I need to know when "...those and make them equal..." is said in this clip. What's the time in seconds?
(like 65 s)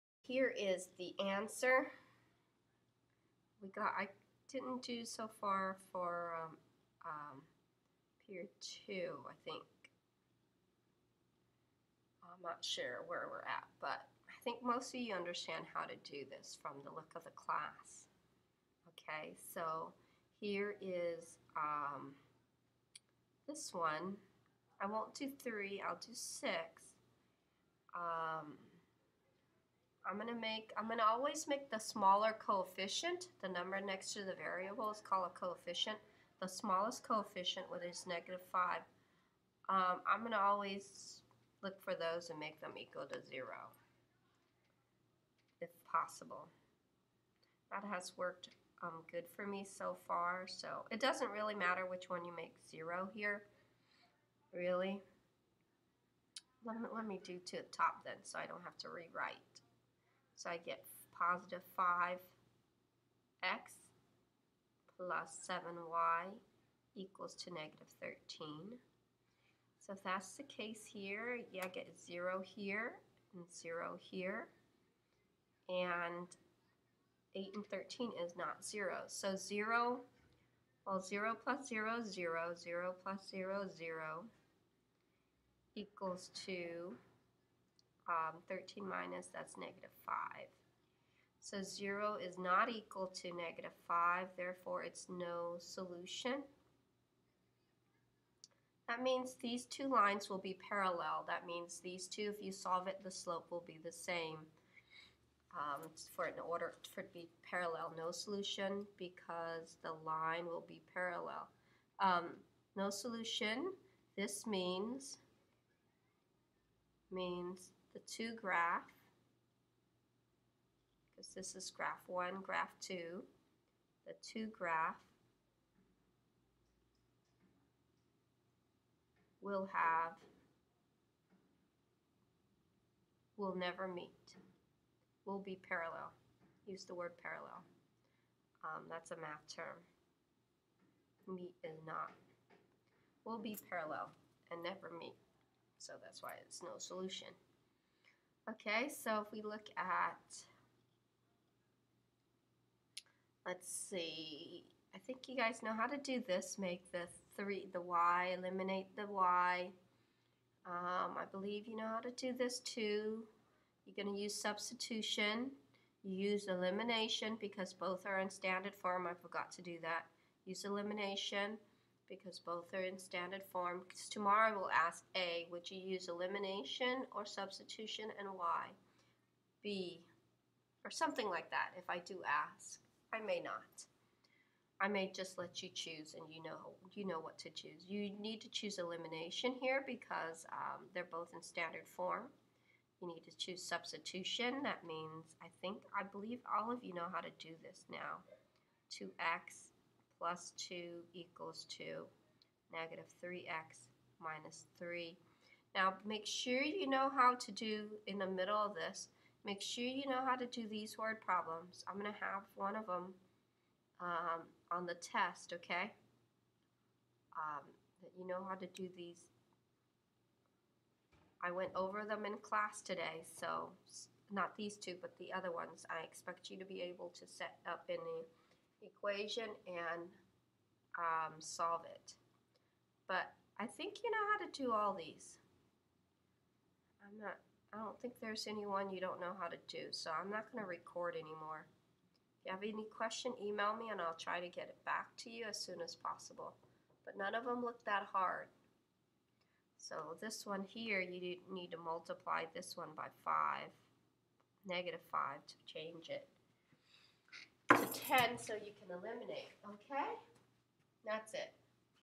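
41 s.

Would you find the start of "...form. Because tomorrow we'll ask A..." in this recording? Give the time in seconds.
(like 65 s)
173 s.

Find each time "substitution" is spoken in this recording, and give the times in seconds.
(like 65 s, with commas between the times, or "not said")
164 s, 177 s, 193 s.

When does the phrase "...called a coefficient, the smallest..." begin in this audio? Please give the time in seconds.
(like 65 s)
35 s.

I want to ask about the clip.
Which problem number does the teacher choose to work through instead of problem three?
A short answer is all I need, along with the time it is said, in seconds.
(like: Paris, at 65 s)
6, at 25 s.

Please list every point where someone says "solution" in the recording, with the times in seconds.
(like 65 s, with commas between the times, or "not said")
95 s, 108 s, 112 s, 146 s.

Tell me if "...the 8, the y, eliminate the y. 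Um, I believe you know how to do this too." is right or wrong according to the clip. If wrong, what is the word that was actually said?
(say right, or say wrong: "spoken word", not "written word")
wrong: "3", not "8".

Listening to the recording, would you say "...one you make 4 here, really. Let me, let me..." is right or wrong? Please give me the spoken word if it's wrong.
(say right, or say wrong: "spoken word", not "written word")
wrong: "0", not "4".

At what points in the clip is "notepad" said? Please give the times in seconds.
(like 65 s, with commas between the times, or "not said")
not said.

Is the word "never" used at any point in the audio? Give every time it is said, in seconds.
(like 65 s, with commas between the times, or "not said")
133 s, 144 s.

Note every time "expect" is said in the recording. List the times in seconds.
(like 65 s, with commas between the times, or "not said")
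226 s.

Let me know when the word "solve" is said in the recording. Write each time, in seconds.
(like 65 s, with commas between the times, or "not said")
102 s, 231 s.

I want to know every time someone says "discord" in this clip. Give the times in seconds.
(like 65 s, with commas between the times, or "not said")
not said.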